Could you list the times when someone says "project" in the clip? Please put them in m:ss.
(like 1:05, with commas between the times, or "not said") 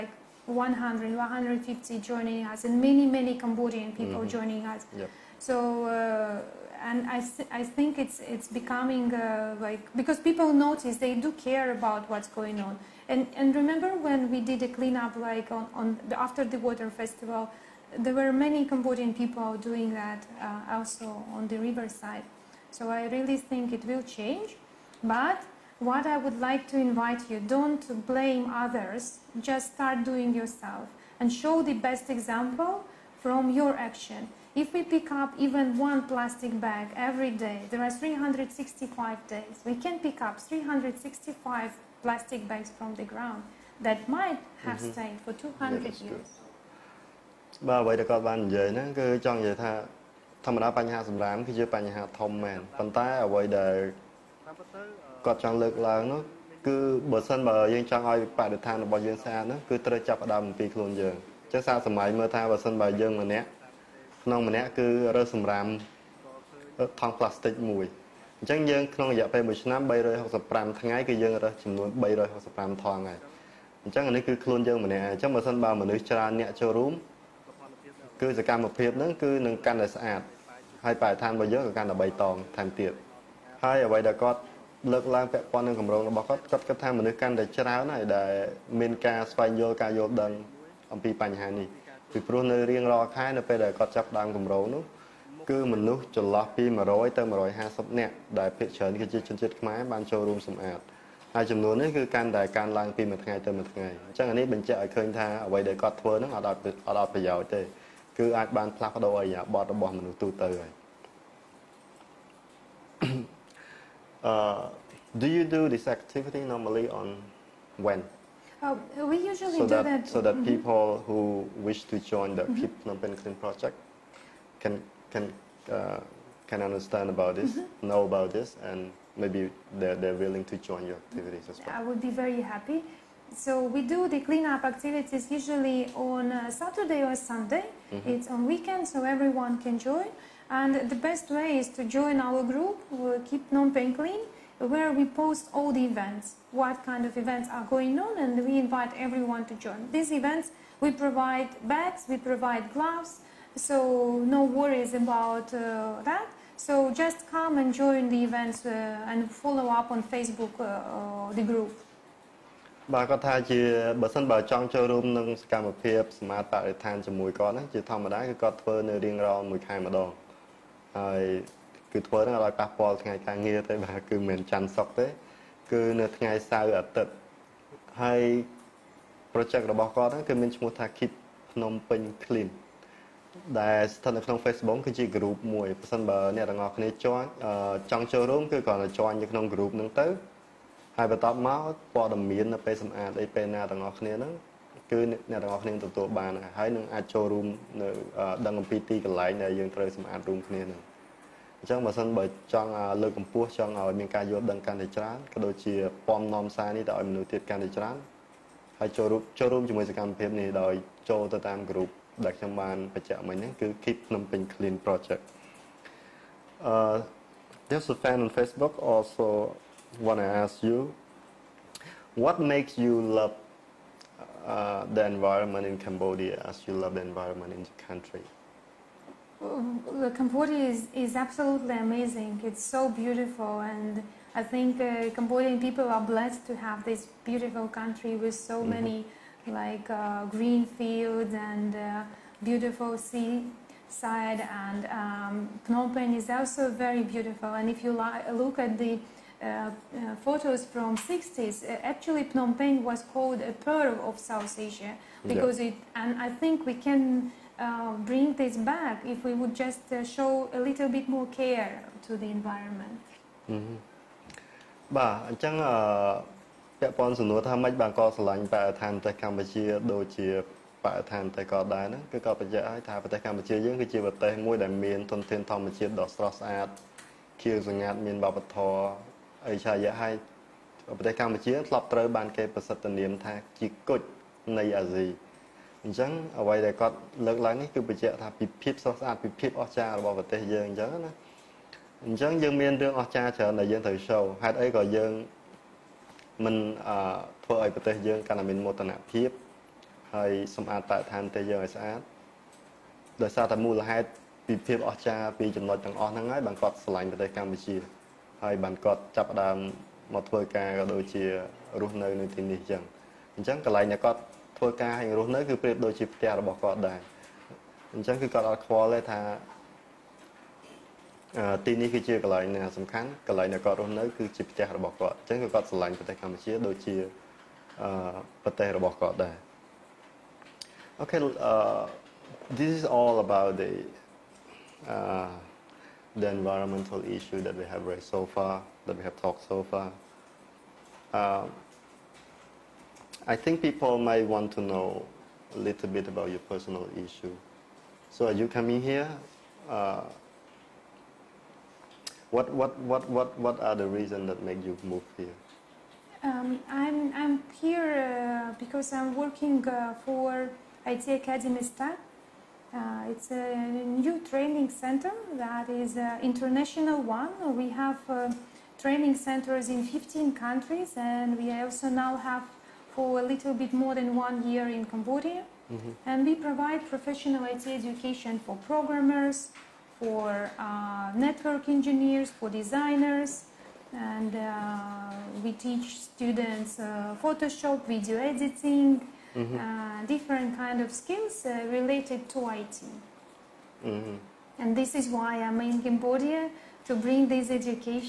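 2:03, 2:59, 3:34.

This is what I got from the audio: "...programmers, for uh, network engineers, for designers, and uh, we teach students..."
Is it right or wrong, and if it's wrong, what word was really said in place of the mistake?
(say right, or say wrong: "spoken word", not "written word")
right.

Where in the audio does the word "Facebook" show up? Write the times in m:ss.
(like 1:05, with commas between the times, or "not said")
2:40, 3:04, 3:38.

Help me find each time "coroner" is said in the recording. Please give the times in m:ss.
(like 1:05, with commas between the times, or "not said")
not said.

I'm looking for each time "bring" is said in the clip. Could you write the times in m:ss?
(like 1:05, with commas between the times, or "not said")
4:18, 6:37.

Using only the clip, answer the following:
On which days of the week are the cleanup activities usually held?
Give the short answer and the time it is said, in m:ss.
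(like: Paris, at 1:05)
Saturday or Sunday, at 2:16.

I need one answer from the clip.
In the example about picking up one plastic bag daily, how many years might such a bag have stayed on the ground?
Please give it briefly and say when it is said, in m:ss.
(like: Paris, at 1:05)
200, at 0:45.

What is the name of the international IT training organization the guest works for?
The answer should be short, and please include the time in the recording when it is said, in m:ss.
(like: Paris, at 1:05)
IT Academy STAN, at 6:00.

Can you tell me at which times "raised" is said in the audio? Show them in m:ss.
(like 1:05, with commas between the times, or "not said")
5:37.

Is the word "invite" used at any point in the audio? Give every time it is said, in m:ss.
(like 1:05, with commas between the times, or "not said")
0:26, 2:28.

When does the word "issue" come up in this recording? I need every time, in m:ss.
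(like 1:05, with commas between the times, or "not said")
5:37, 5:46.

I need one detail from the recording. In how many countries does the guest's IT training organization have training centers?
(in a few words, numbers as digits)
15.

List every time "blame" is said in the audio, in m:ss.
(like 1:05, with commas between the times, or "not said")
0:28.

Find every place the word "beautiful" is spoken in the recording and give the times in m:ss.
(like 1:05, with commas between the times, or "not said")
3:52, 3:57, 4:02, 4:07.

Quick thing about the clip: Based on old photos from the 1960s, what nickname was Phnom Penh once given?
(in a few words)
Pearl of South Asia.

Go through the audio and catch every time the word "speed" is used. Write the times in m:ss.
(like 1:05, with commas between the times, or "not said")
not said.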